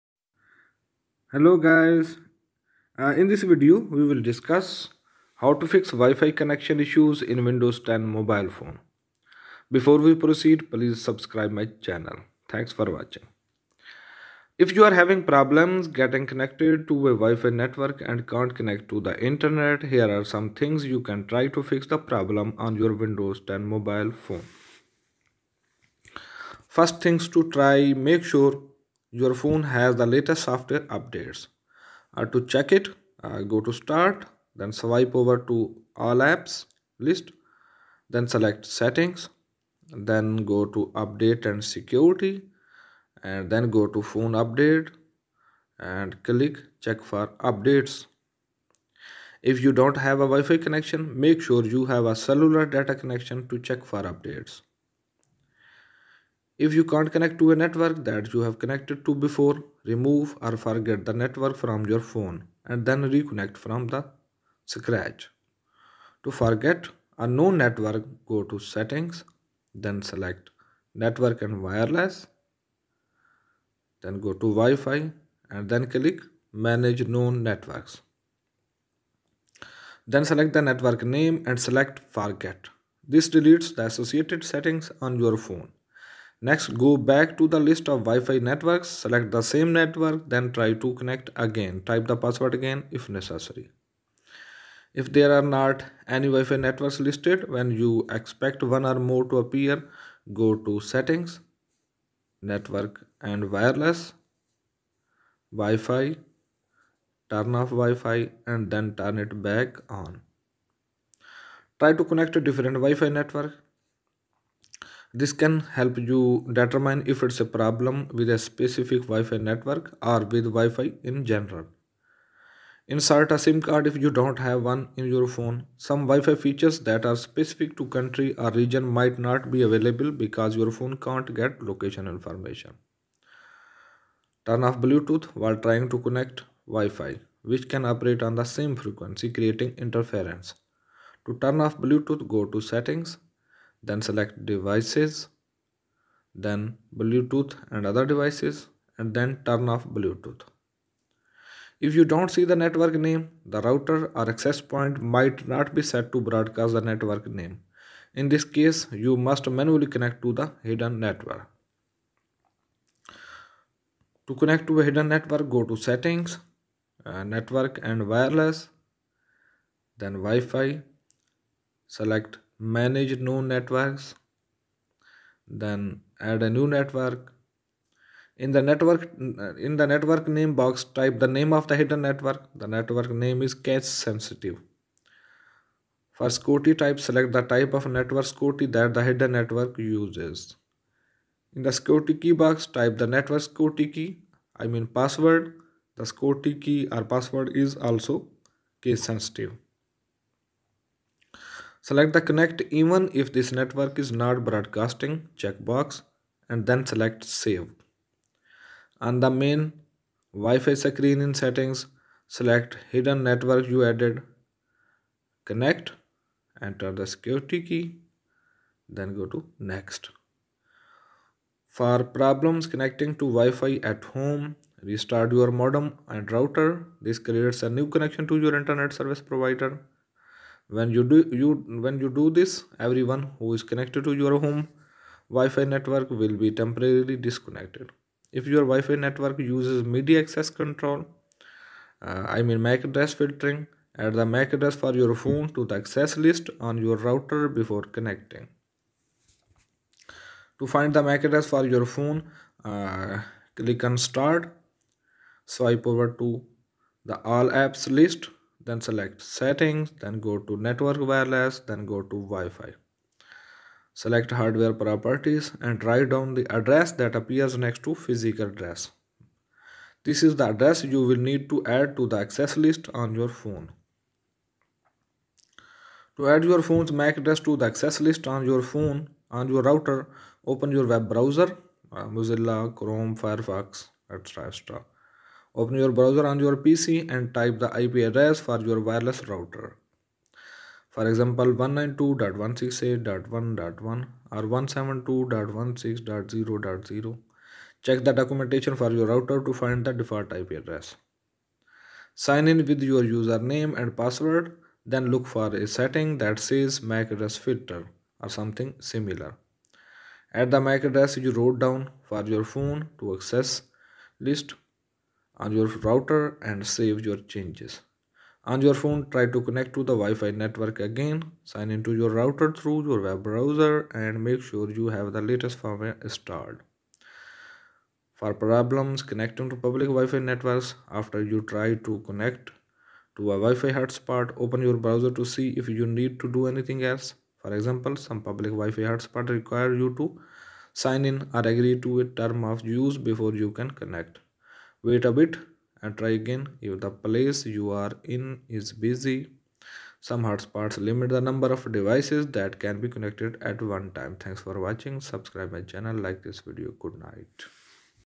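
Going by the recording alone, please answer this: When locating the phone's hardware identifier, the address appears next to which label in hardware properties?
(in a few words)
Physical address.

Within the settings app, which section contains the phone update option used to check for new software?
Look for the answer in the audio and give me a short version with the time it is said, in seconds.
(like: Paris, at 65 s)
Update and security, at 40 s.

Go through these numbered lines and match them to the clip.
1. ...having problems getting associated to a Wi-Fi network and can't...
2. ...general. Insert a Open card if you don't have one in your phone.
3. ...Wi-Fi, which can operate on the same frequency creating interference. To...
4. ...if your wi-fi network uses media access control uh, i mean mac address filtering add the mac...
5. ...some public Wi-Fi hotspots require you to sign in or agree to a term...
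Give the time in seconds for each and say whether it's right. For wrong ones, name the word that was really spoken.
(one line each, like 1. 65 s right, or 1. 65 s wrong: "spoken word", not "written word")
1. 14 s wrong: "connected", not "associated"
2. 121 s wrong: "SIM", not "Open"
3. 136 s right
4. 238 s right
5. 337 s right.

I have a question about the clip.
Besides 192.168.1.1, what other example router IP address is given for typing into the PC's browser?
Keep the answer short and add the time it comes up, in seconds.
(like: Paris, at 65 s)
172.16.0.0, at 294 s.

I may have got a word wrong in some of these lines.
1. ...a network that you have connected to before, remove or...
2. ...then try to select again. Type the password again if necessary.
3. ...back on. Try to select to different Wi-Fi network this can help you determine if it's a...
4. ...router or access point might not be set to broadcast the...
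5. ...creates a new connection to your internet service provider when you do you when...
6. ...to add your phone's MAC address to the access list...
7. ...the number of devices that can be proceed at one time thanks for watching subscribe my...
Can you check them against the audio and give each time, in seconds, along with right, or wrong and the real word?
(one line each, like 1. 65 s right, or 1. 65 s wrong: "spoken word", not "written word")
1. 57 s right
2. 90 s wrong: "connect", not "select"
3. 109 s wrong: "connect", not "select"
4. 153 s right
5. 227 s right
6. 276 s right
7. 351 s wrong: "connected", not "proceed".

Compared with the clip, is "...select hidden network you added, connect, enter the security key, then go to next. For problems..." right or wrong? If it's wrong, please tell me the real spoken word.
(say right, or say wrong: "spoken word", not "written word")
right.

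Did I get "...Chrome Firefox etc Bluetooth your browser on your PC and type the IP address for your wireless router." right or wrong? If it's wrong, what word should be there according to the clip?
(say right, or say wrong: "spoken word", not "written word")
wrong: "Open", not "Bluetooth".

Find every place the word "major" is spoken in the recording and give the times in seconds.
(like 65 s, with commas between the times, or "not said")
not said.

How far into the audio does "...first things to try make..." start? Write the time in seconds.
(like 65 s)
26 s.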